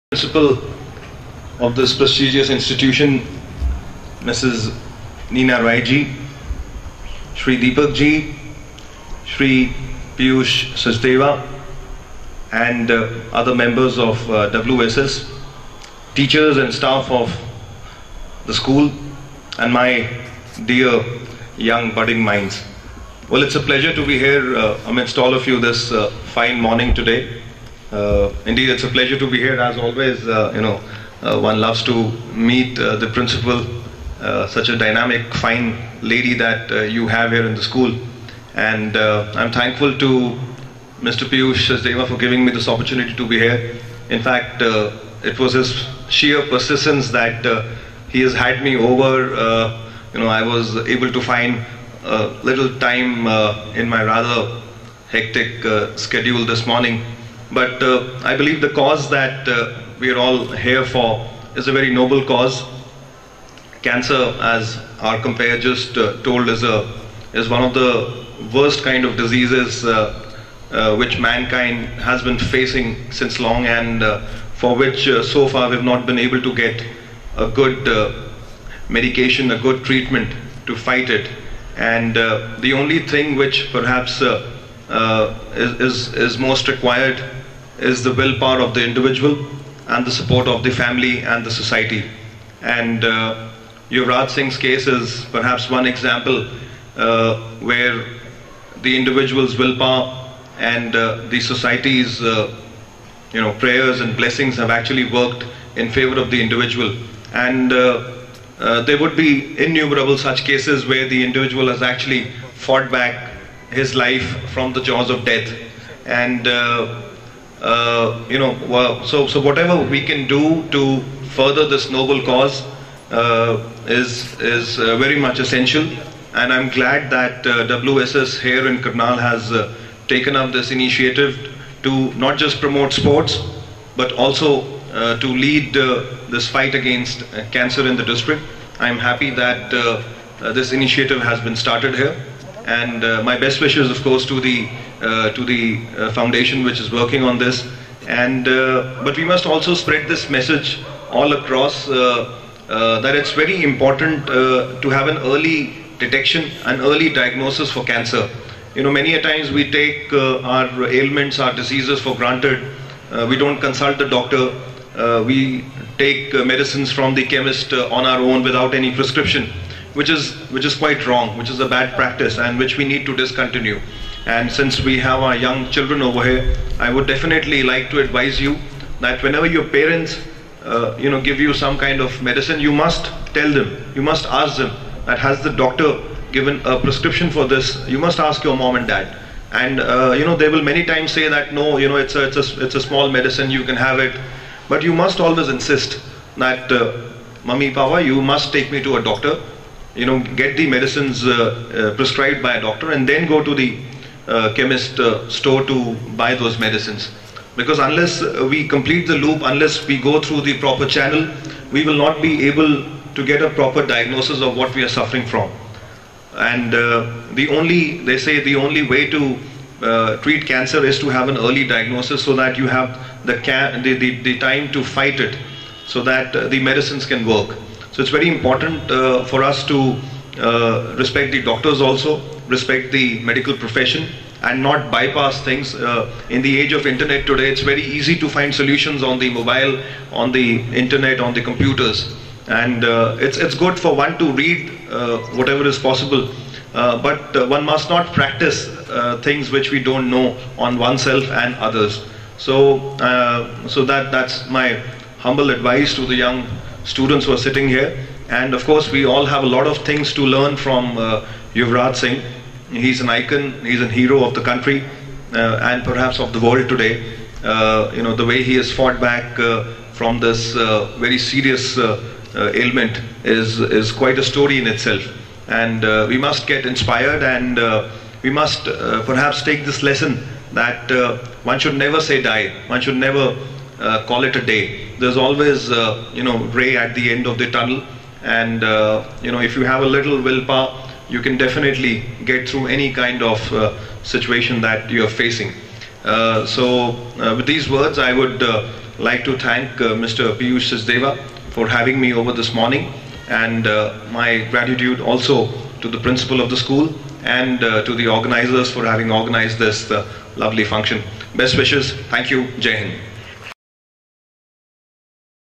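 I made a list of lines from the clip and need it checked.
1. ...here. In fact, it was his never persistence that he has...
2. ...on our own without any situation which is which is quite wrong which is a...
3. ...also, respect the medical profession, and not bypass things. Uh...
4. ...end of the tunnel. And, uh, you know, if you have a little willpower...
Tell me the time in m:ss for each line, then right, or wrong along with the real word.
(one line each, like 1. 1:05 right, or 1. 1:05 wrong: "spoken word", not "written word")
1. 0:43 wrong: "sheer", not "never"
2. 2:47 wrong: "prescription", not "situation"
3. 3:51 right
4. 4:47 right.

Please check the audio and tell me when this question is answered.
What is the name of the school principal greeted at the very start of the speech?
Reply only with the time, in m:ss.
0:04.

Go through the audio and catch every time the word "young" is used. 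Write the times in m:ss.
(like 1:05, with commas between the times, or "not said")
0:21, 2:55, 4:16.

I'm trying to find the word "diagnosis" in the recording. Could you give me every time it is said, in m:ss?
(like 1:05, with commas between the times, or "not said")
2:37, 3:33, 3:41.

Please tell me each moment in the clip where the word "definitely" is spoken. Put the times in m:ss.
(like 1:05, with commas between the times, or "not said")
2:57, 4:51.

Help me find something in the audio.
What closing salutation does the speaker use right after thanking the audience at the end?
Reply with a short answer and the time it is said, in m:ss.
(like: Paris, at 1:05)
Jai Hind, at 5:12.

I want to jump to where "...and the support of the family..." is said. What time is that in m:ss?
1:29.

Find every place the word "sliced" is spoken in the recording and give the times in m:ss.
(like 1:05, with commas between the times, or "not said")
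not said.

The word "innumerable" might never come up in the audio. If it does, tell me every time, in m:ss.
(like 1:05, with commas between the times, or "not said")
1:49.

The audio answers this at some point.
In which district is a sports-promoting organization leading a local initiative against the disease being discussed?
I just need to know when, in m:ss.
2:08.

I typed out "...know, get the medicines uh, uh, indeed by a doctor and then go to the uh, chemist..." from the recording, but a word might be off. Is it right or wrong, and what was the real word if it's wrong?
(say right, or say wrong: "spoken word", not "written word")
wrong: "prescribed", not "indeed".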